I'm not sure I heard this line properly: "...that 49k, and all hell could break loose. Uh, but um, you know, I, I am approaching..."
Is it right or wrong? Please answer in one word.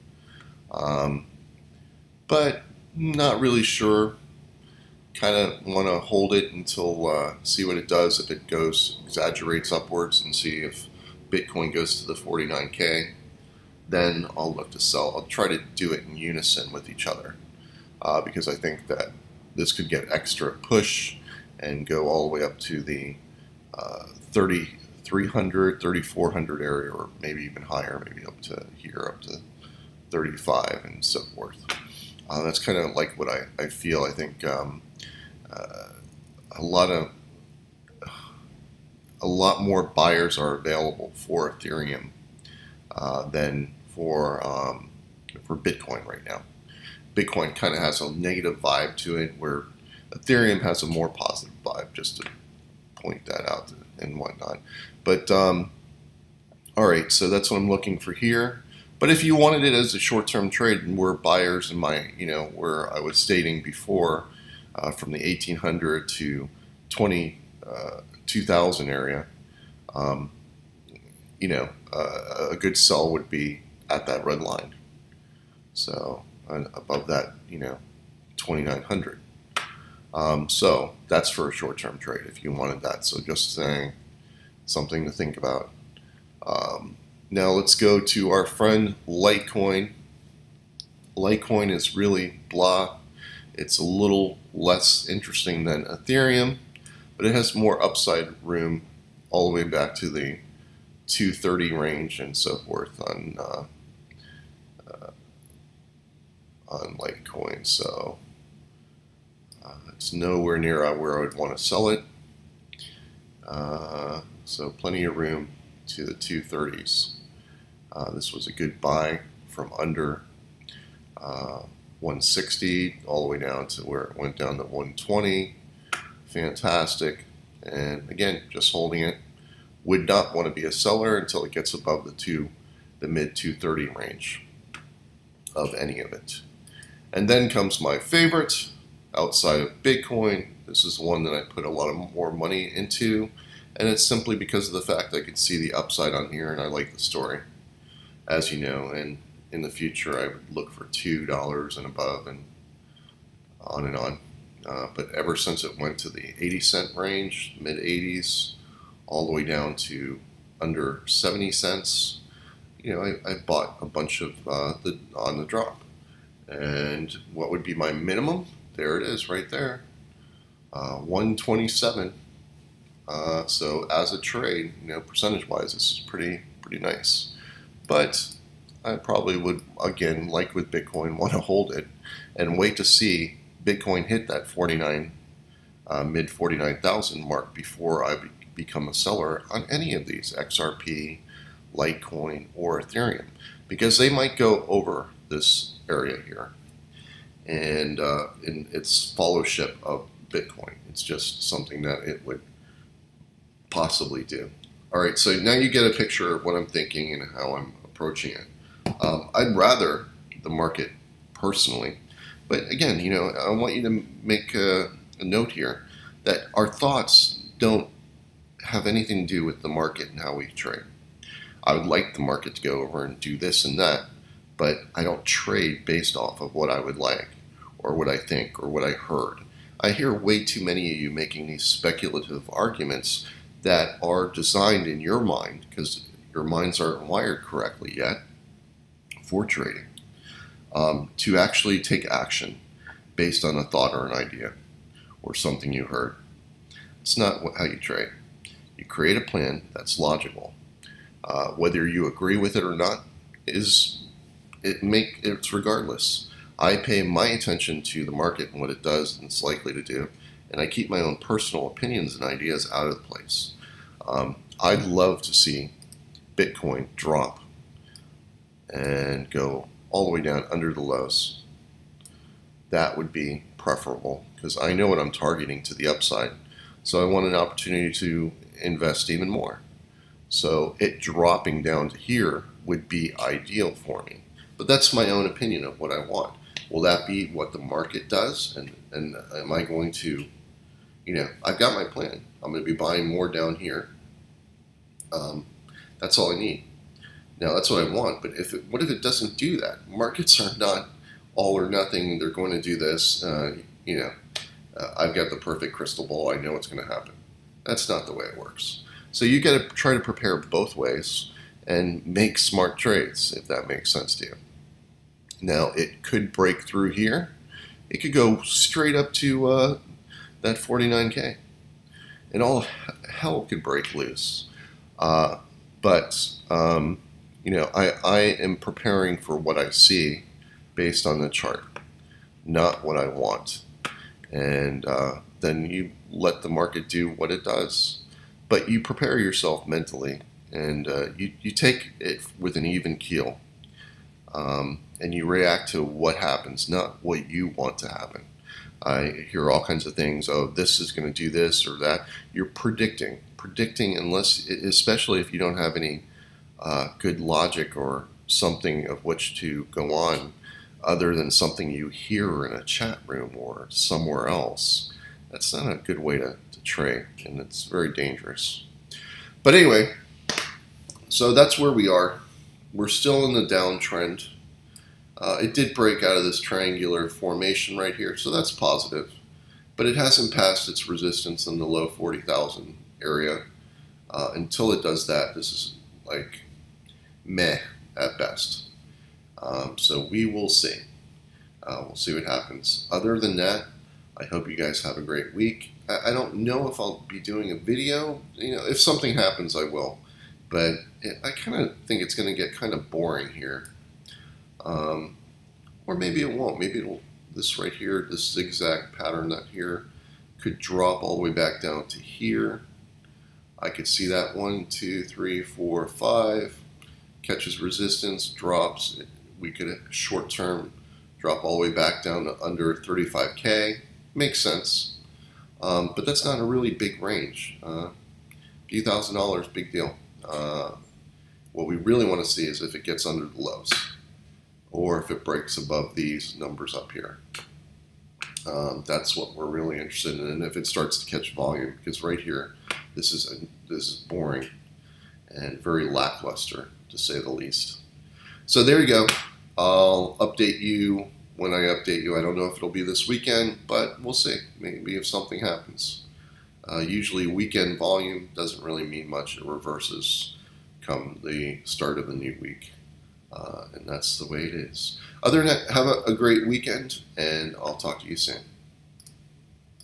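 wrong.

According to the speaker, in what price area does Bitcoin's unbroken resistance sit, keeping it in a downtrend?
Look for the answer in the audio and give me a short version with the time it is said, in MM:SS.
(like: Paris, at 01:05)
low 40,000s, at 06:21.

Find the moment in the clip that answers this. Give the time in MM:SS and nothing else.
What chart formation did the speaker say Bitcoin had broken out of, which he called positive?
06:16.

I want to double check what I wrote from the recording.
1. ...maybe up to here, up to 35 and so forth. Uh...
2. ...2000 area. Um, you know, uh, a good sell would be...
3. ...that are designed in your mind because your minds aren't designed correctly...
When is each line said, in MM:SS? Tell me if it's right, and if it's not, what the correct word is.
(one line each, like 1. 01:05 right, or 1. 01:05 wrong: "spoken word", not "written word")
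1. 00:28 right
2. 01:08 right
3. 03:53 wrong: "wired", not "designed".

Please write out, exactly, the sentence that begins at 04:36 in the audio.
So I want an opportunity to invest even more.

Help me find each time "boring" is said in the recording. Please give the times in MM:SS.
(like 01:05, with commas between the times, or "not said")
06:42, 07:24.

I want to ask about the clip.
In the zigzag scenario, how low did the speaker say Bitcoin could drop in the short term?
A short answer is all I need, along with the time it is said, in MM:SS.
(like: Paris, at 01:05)
under 35K, at 07:02.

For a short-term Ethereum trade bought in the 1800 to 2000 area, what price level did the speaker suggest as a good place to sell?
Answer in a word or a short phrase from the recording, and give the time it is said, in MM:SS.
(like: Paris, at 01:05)
2900, at 01:18.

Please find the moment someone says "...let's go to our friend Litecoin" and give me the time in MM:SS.
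01:27.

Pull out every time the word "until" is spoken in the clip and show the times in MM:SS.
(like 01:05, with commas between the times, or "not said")
00:06, 02:11, 06:24.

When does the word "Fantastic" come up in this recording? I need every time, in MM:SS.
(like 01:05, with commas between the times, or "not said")
02:06.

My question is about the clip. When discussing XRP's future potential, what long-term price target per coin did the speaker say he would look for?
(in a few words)
$2 and above.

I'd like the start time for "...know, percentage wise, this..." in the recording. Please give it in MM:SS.
02:54.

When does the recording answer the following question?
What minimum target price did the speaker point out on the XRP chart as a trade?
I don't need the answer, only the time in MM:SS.
02:50.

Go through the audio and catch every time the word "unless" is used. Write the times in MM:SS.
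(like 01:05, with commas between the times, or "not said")
05:53.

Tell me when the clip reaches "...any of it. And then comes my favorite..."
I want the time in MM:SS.
02:15.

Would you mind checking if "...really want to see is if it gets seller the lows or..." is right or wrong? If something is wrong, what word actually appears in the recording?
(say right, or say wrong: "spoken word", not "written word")
wrong: "under", not "seller".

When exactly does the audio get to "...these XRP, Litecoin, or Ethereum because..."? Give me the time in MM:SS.
03:10.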